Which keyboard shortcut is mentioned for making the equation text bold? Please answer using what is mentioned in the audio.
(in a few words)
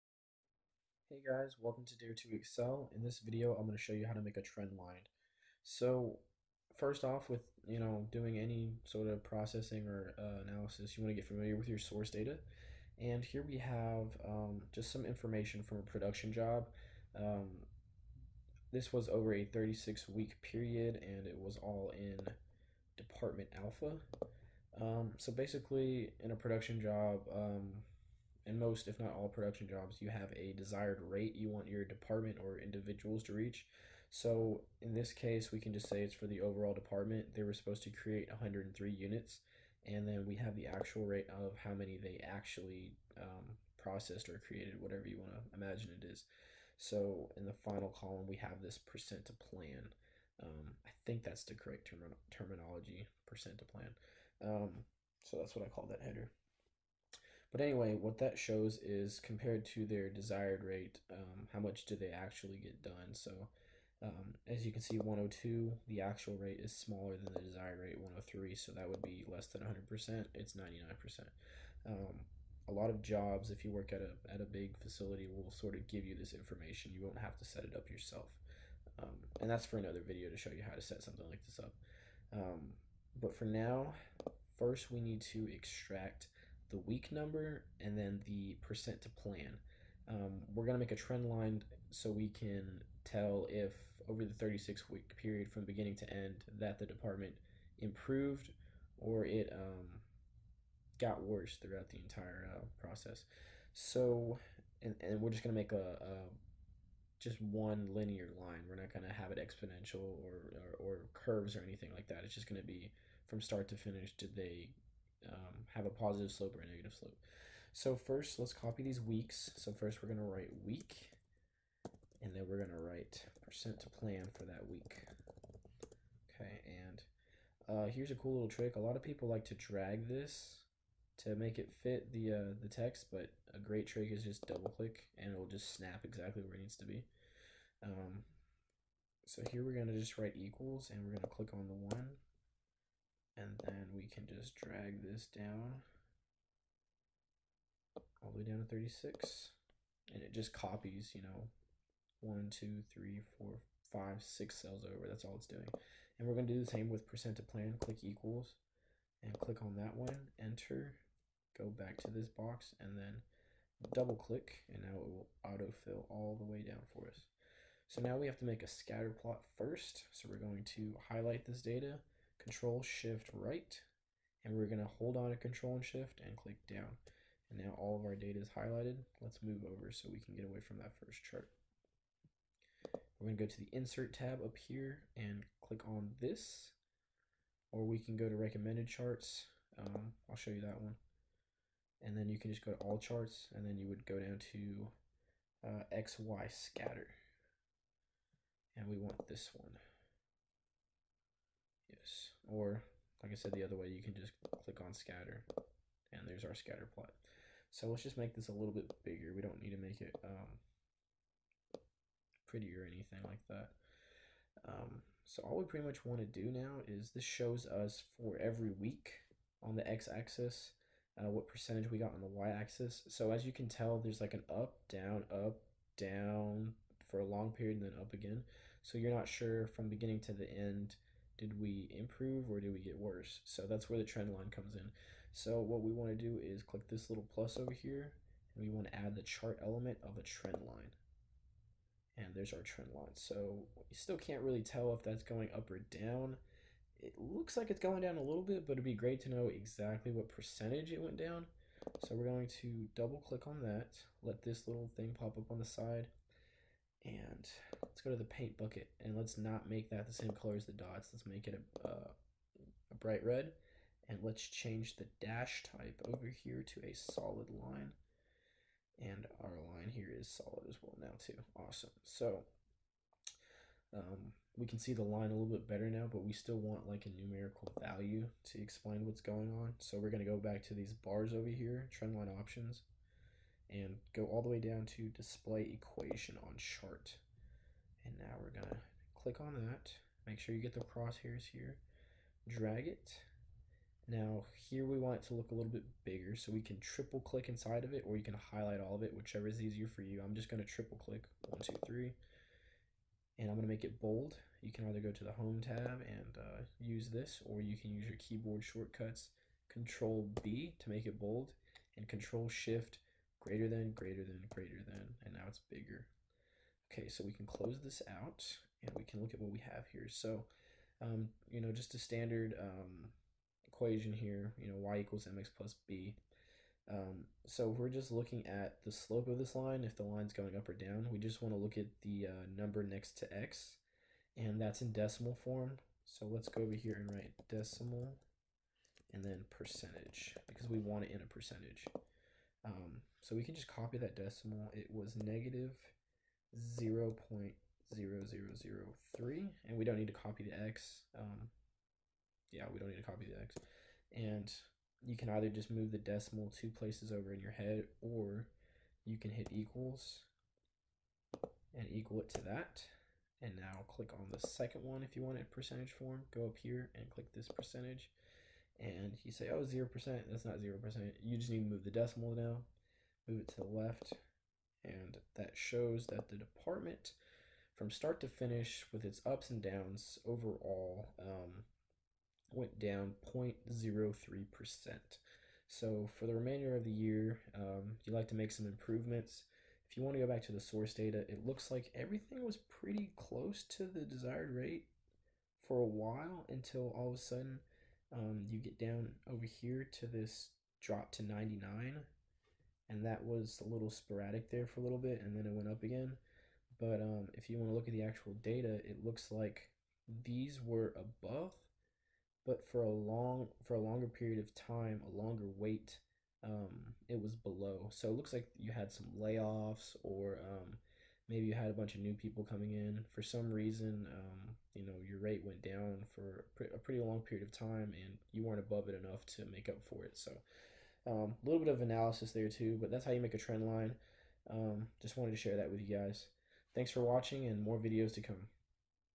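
Control B.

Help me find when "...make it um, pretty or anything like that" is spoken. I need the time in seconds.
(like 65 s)
209 s.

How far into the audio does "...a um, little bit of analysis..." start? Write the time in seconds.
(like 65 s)
431 s.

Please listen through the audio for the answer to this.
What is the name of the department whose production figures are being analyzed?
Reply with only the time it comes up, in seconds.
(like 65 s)
22 s.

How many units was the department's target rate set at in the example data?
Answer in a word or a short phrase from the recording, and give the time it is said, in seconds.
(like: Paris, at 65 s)
103, at 38 s.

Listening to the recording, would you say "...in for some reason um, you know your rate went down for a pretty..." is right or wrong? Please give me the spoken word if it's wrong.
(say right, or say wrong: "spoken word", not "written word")
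right.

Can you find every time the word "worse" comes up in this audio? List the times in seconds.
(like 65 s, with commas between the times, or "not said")
101 s, 232 s.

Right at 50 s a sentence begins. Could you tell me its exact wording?
Um, I think that's the correct term- terminology, percent to plan.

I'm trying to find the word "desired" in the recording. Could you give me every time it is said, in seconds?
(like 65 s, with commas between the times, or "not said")
30 s, 60 s, 67 s, 394 s.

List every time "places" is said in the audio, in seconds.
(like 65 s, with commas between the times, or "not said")
356 s.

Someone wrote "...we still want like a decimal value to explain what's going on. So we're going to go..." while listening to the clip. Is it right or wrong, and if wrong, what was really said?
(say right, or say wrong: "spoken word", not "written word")
wrong: "numerical", not "decimal".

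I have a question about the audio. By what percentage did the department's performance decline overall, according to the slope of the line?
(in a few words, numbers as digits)
0.03%.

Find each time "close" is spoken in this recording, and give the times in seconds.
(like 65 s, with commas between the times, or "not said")
317 s, 393 s.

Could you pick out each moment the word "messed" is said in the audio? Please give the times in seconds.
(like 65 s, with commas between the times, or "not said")
not said.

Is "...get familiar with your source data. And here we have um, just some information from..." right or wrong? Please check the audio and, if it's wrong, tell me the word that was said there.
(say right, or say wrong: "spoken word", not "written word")
right.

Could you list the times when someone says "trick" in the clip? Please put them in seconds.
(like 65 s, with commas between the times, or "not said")
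128 s, 133 s.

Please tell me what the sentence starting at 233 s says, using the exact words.
So that's where the trend line comes in.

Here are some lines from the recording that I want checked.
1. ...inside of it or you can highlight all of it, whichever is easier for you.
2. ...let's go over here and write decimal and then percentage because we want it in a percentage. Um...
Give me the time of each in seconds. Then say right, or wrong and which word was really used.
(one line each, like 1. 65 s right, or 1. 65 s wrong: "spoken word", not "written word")
1. 297 s right
2. 336 s right.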